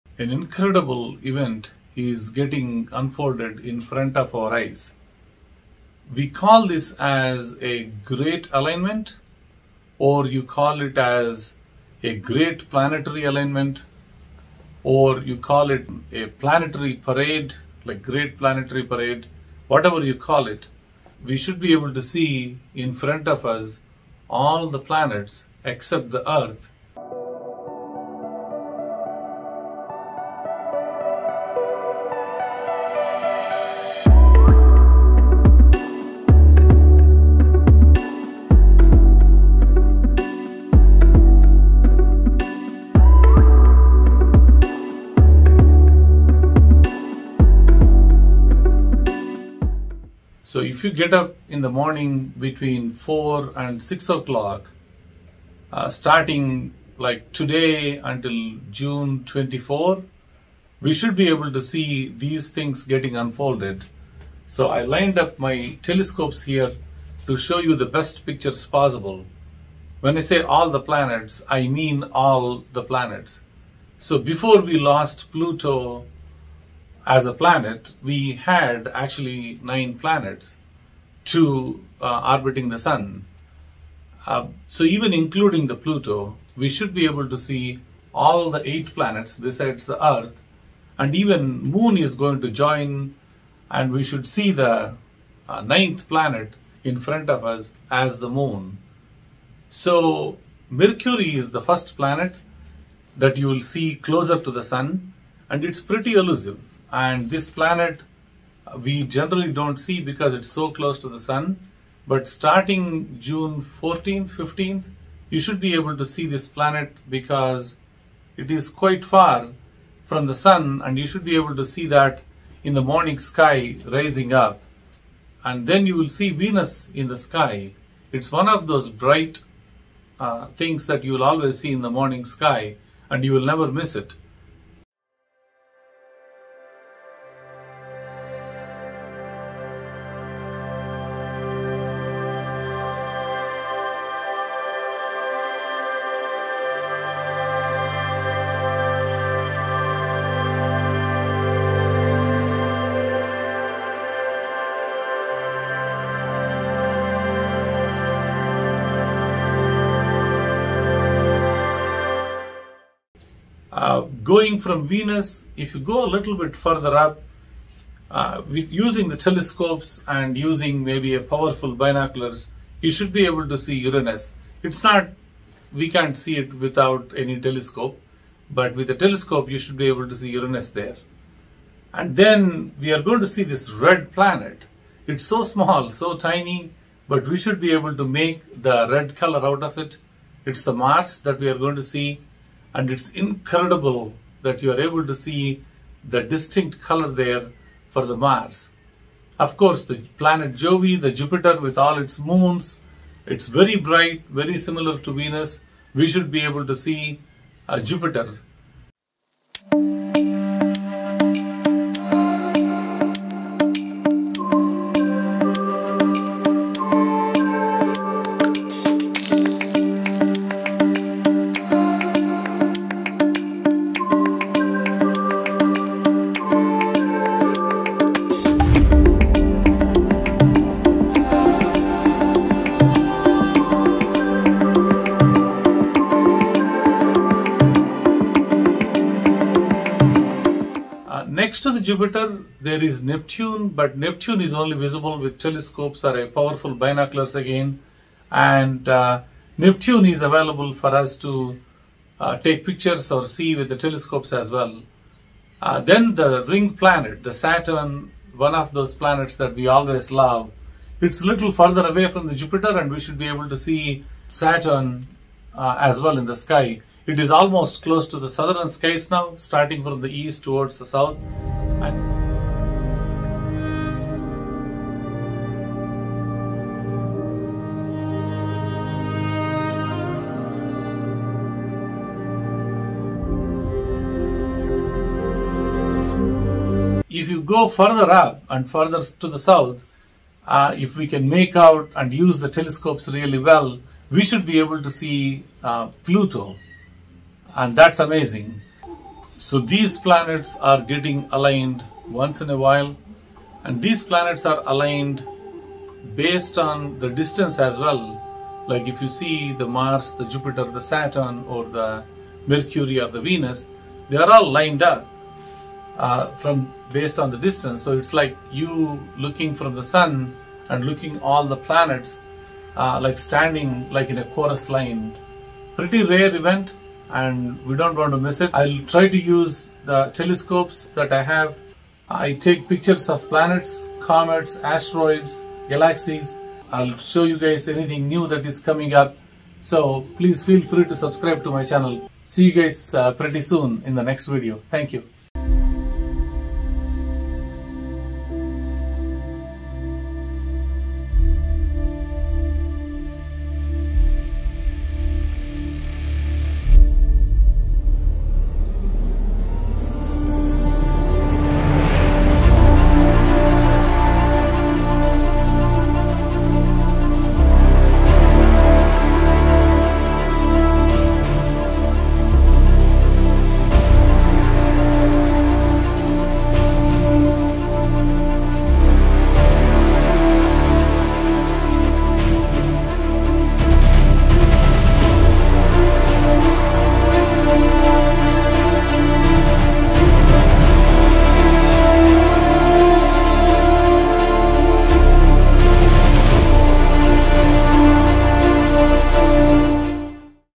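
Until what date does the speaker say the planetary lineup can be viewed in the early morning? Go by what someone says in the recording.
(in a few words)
June 24.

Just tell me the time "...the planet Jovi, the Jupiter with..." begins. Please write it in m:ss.
3:19.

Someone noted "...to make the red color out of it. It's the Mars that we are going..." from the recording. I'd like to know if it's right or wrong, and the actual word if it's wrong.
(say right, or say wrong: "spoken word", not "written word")
right.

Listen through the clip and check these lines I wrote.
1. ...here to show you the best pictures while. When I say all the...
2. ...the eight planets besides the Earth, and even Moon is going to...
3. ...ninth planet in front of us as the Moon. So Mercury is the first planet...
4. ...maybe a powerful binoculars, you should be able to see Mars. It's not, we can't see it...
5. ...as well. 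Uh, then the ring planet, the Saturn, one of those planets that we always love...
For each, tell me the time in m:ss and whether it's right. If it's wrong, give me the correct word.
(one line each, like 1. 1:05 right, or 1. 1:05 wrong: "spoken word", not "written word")
1. 1:06 wrong: "possible", not "while"
2. 1:28 right
3. 1:35 right
4. 2:50 wrong: "Uranus", not "Mars"
5. 4:14 right.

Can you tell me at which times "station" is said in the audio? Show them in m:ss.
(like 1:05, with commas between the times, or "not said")
not said.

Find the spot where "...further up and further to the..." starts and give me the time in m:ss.
4:47.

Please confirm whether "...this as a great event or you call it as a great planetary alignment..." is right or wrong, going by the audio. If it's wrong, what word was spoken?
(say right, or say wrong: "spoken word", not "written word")
wrong: "alignment", not "event".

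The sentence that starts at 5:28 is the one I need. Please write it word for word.
I'll try to use the telescopes that I have.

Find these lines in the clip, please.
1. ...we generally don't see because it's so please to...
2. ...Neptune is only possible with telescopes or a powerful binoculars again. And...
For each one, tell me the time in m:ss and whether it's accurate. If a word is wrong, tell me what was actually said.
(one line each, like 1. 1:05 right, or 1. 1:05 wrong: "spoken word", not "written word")
1. 1:48 wrong: "close", not "please"
2. 4:03 wrong: "visible", not "possible".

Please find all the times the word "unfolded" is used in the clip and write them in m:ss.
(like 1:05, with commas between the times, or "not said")
0:03, 1:03.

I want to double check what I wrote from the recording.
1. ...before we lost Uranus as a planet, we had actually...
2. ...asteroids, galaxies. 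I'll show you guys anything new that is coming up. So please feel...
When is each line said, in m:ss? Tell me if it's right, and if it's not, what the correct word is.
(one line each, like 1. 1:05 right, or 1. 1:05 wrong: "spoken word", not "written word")
1. 1:14 wrong: "Pluto", not "Uranus"
2. 5:34 right.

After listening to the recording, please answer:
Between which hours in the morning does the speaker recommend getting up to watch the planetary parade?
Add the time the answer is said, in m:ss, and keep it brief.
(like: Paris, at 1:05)
4 and 6, at 0:52.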